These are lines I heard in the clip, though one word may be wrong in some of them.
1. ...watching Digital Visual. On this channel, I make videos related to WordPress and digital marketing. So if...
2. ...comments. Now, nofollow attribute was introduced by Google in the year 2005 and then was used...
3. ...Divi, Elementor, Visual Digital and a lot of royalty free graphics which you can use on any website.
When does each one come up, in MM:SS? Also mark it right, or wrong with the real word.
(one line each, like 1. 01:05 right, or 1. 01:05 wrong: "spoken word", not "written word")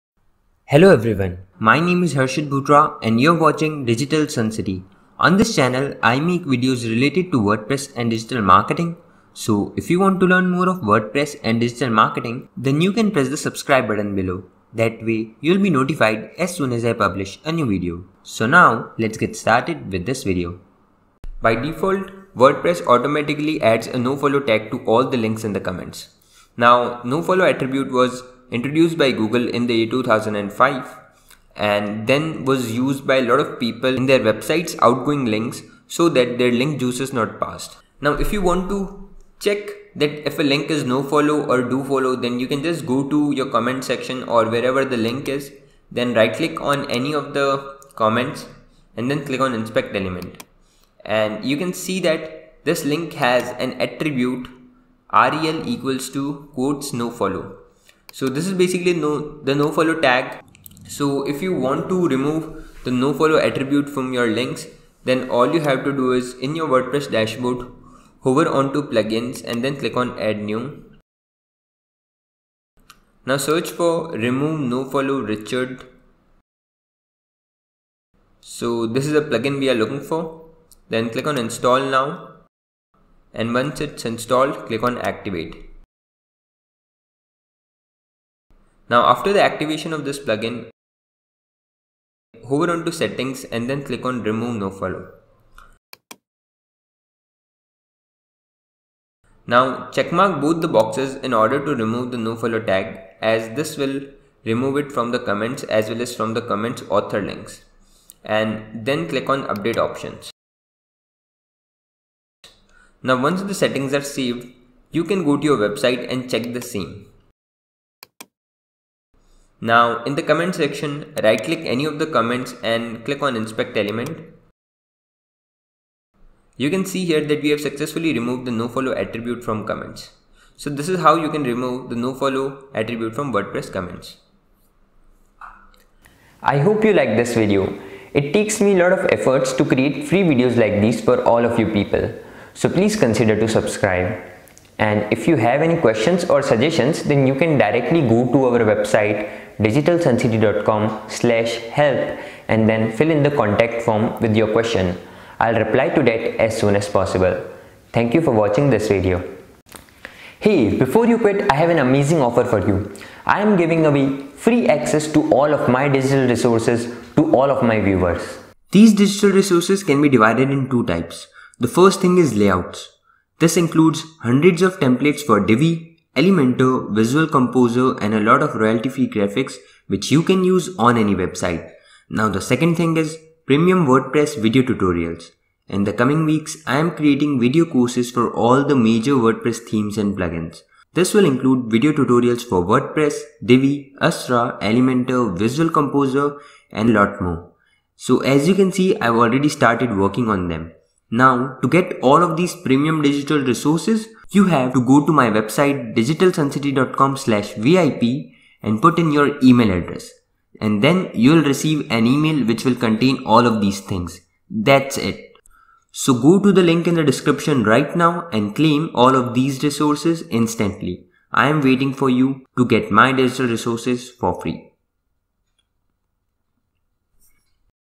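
1. 00:03 wrong: "Suncity", not "Visual"
2. 00:25 right
3. 02:55 wrong: "Composer", not "Digital".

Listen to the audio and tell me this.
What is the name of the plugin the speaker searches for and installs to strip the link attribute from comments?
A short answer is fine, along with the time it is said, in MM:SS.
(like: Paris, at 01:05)
Remove Nofollow, at 01:14.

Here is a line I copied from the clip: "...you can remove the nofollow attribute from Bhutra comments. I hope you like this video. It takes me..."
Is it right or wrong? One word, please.
wrong.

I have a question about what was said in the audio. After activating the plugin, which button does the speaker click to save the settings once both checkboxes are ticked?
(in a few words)
Update options.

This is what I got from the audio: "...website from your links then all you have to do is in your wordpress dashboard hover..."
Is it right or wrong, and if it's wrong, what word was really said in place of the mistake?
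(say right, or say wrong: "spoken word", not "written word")
wrong: "attribute", not "website".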